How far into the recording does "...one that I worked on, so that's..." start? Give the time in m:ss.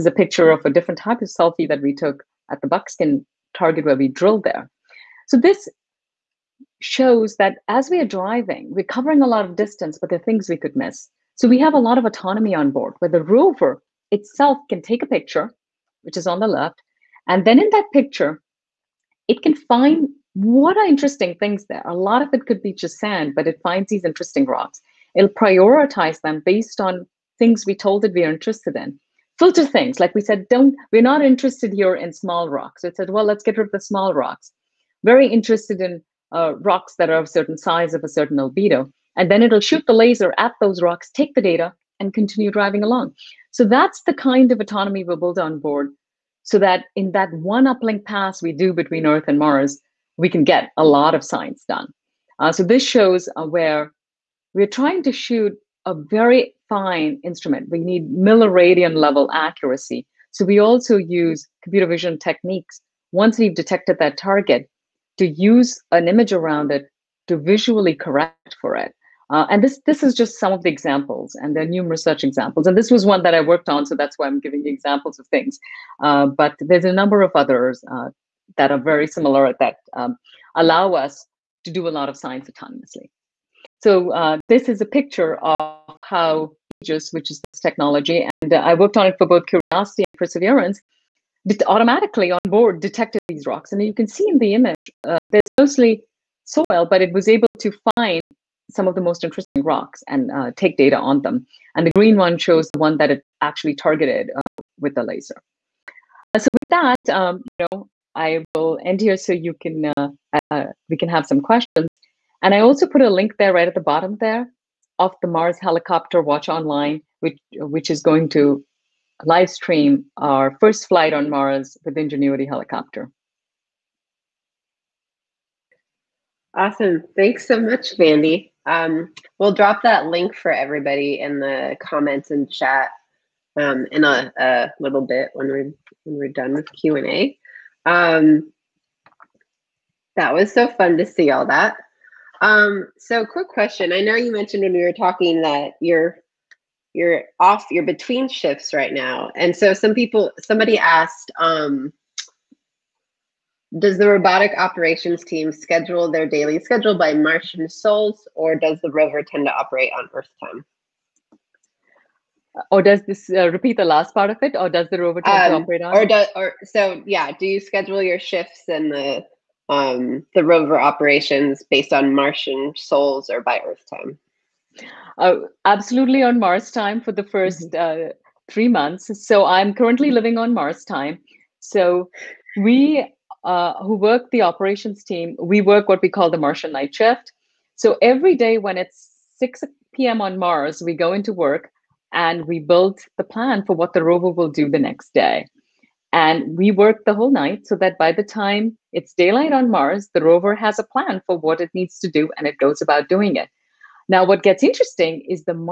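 1:13.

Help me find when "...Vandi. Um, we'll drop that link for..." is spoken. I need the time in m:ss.
2:07.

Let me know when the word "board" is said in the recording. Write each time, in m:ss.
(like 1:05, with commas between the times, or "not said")
0:12, 0:45, 1:32.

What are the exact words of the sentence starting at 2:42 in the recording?
Or does this uh, repeat the last part of it, or does the rover tend um, to operate on?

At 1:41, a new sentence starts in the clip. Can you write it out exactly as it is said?
And the green one shows the one that it actually targeted uh, with the laser.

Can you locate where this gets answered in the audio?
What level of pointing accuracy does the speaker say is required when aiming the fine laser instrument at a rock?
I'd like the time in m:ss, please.
0:58.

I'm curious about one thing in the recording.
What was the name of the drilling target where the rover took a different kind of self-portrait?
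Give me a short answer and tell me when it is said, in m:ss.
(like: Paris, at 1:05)
Buckskin, at 0:02.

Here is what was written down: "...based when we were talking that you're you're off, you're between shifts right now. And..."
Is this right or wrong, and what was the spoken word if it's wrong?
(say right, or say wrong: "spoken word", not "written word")
wrong: "mentioned", not "based".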